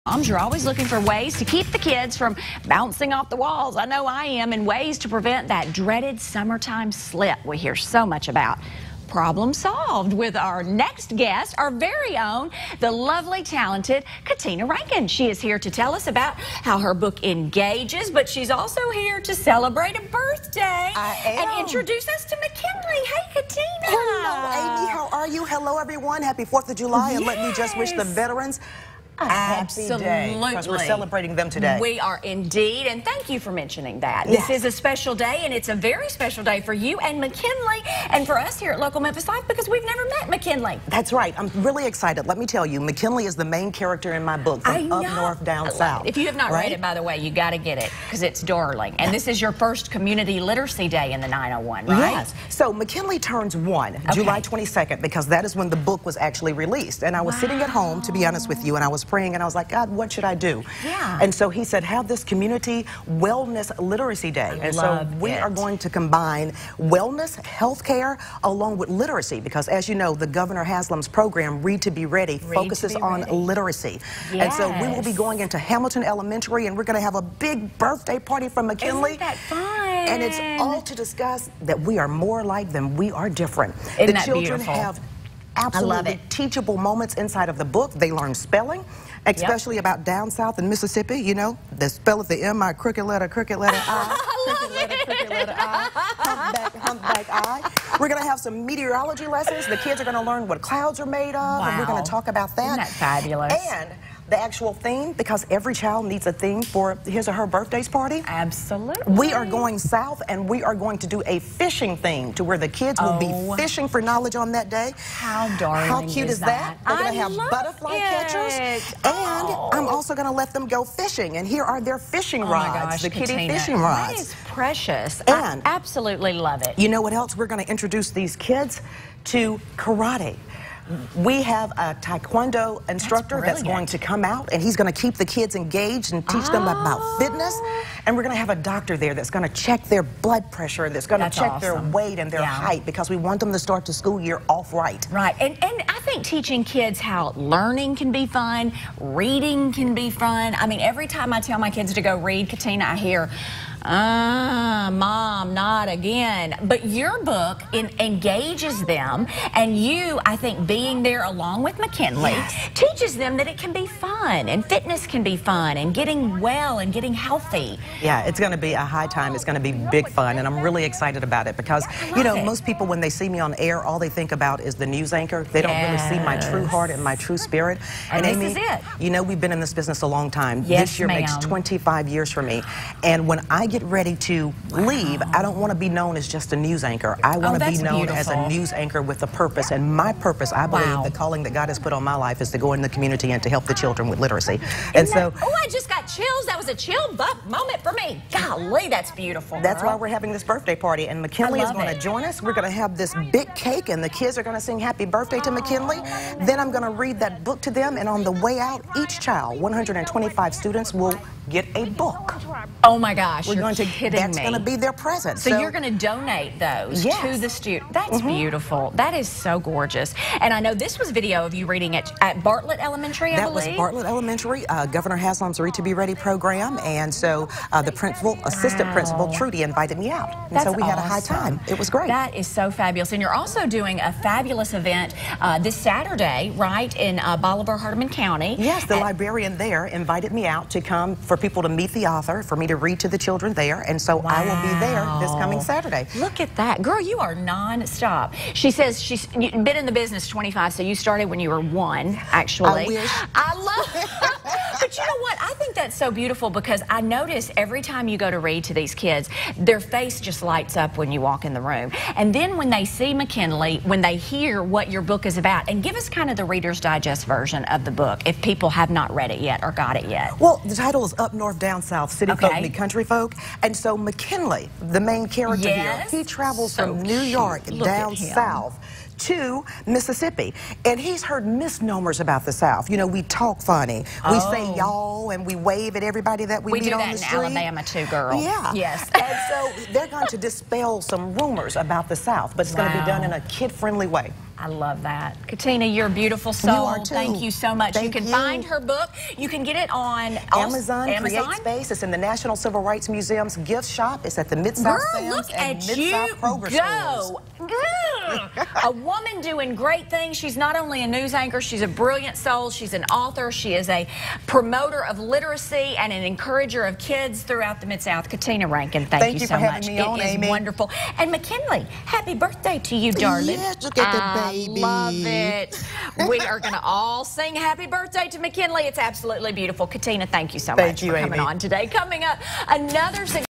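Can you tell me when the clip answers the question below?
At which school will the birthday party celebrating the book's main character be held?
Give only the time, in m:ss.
1:15.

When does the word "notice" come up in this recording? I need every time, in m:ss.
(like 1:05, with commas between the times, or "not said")
4:17.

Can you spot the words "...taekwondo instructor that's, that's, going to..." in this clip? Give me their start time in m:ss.
2:12.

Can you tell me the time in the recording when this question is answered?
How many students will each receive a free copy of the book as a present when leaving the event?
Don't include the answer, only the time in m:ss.
3:29.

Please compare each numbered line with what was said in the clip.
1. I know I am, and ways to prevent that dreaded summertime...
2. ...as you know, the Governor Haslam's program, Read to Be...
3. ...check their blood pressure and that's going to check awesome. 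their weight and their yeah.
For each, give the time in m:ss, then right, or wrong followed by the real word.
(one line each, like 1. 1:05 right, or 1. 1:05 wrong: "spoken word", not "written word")
1. 0:03 right
2. 1:09 right
3. 2:19 right.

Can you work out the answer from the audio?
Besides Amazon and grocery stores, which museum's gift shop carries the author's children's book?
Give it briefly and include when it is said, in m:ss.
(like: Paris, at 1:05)
National Civil Rights Museum, at 5:02.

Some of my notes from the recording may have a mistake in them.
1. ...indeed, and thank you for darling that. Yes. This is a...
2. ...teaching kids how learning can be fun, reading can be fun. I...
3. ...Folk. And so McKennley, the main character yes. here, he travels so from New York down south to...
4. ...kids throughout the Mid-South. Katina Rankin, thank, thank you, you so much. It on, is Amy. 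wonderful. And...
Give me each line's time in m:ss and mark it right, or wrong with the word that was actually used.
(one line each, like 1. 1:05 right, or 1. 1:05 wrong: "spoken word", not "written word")
1. 0:32 wrong: "mentioning", not "darling"
2. 2:26 right
3. 4:33 right
4. 5:16 right.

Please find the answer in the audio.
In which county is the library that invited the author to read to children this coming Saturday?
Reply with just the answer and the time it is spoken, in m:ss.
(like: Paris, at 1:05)
Hardeman County, at 3:57.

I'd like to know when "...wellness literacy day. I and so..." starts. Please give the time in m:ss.
1:03.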